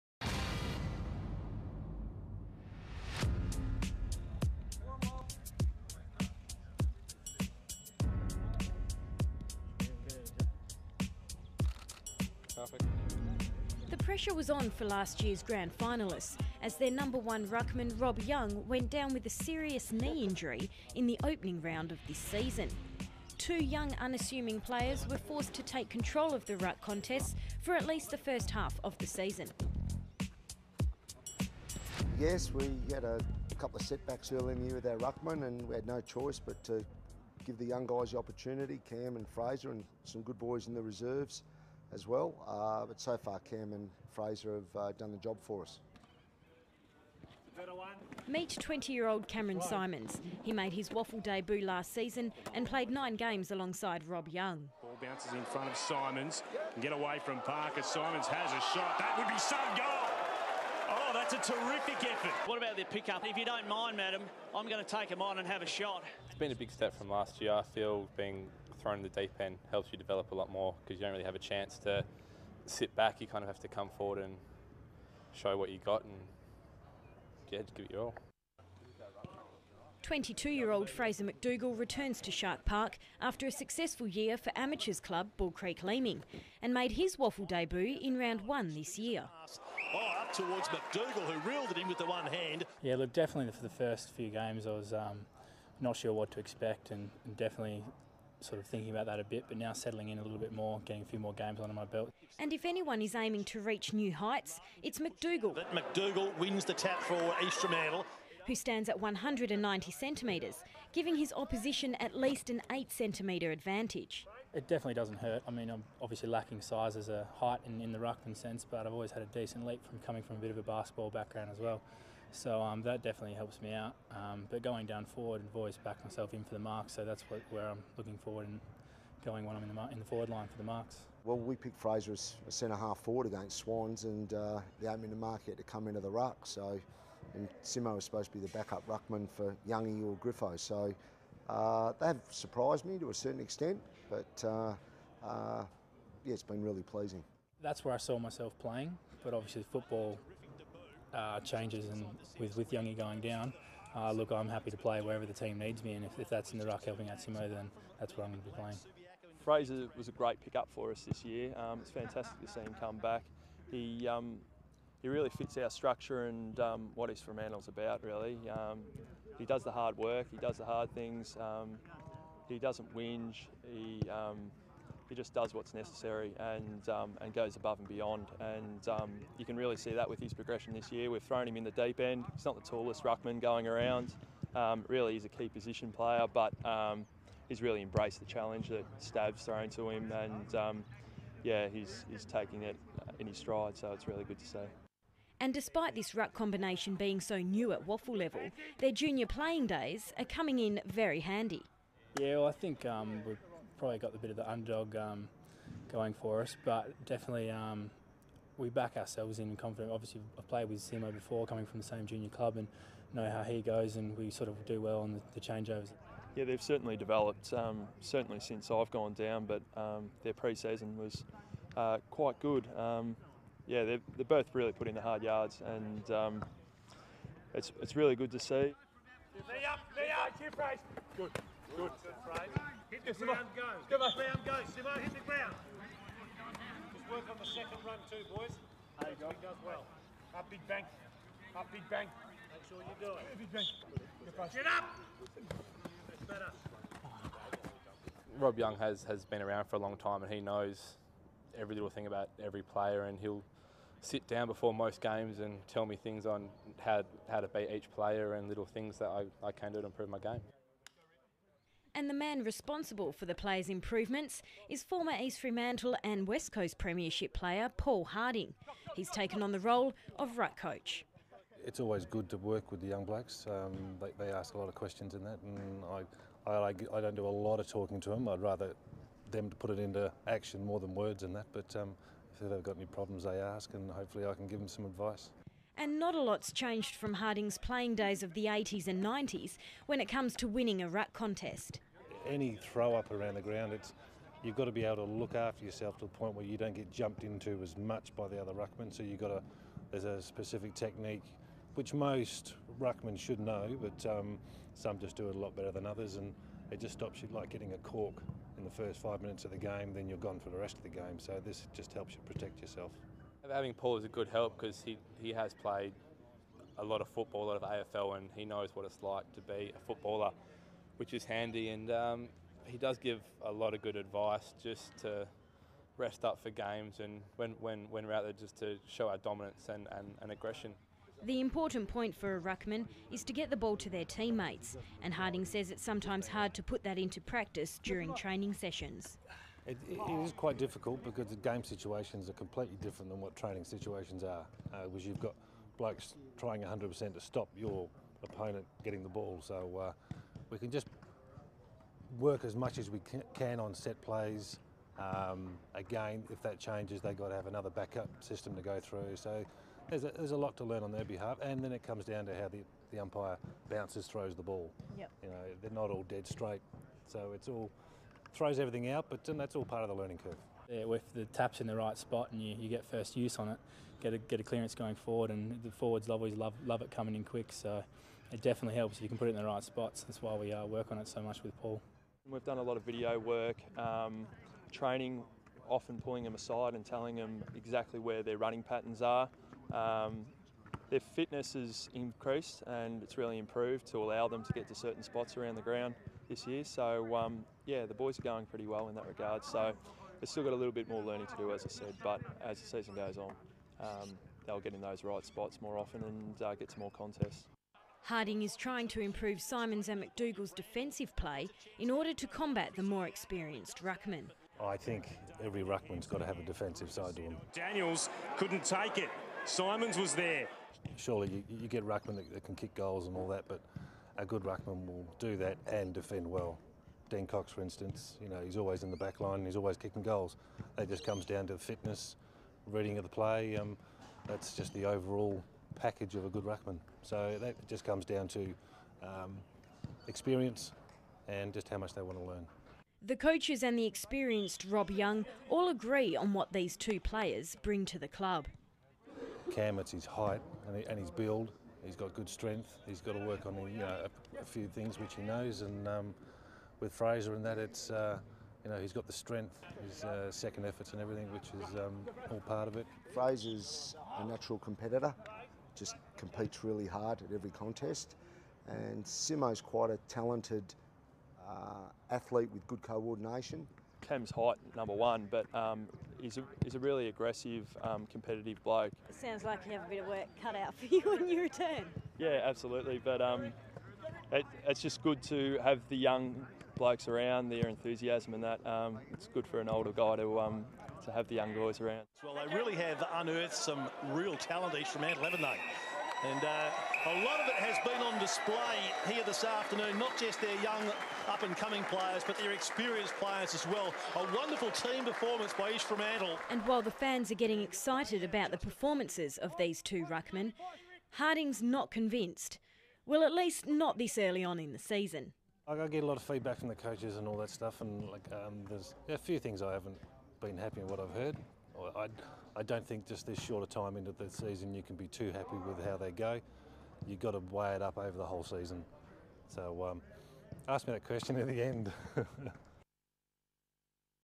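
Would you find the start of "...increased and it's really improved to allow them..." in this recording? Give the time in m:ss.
6:31.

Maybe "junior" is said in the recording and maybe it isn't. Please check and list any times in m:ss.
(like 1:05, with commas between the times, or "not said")
3:18, 3:32.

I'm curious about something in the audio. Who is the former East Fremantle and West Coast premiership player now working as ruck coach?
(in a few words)
Paul Harding.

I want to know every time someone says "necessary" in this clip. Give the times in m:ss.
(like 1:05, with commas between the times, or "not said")
2:55.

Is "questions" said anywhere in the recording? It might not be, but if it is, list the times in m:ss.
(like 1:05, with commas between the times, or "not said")
4:34, 8:51.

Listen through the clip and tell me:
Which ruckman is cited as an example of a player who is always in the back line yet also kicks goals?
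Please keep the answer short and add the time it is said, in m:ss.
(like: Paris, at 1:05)
Dean Cox, at 7:07.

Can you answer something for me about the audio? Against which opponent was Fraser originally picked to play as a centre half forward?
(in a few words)
Swans.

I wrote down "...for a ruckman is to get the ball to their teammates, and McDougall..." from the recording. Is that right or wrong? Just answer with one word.
wrong.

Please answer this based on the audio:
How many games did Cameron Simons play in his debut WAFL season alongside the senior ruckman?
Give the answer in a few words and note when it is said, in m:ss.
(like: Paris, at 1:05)
9, at 0:52.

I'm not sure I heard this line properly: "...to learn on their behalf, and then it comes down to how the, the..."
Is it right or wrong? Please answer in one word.
right.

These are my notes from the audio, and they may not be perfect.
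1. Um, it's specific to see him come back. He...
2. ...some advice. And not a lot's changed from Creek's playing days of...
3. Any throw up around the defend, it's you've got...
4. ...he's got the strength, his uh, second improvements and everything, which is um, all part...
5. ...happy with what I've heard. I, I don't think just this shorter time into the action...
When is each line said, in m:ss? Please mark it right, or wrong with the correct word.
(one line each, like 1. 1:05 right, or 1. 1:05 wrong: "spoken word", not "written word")
1. 2:41 wrong: "fantastic", not "specific"
2. 4:44 wrong: "Harding", not "Creek"
3. 4:52 wrong: "ground", not "defend"
4. 7:38 wrong: "efforts", not "improvements"
5. 8:40 wrong: "season", not "action".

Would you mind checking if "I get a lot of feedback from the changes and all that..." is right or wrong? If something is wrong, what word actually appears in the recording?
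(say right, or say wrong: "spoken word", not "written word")
wrong: "coaches", not "changes".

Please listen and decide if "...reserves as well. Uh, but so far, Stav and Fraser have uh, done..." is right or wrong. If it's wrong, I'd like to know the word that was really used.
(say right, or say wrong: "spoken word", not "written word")
wrong: "Cam", not "Stav".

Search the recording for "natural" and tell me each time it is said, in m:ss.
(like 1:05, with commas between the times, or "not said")
7:44.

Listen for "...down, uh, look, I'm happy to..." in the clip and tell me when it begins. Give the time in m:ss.
2:33.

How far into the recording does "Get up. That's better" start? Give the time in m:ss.
4:04.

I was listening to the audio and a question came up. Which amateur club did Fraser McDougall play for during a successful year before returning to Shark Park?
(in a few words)
Bull Creek Leeming.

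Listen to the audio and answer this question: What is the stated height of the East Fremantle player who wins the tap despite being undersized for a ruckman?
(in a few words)
190 centimetres.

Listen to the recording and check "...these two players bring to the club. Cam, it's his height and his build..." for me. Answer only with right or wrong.
right.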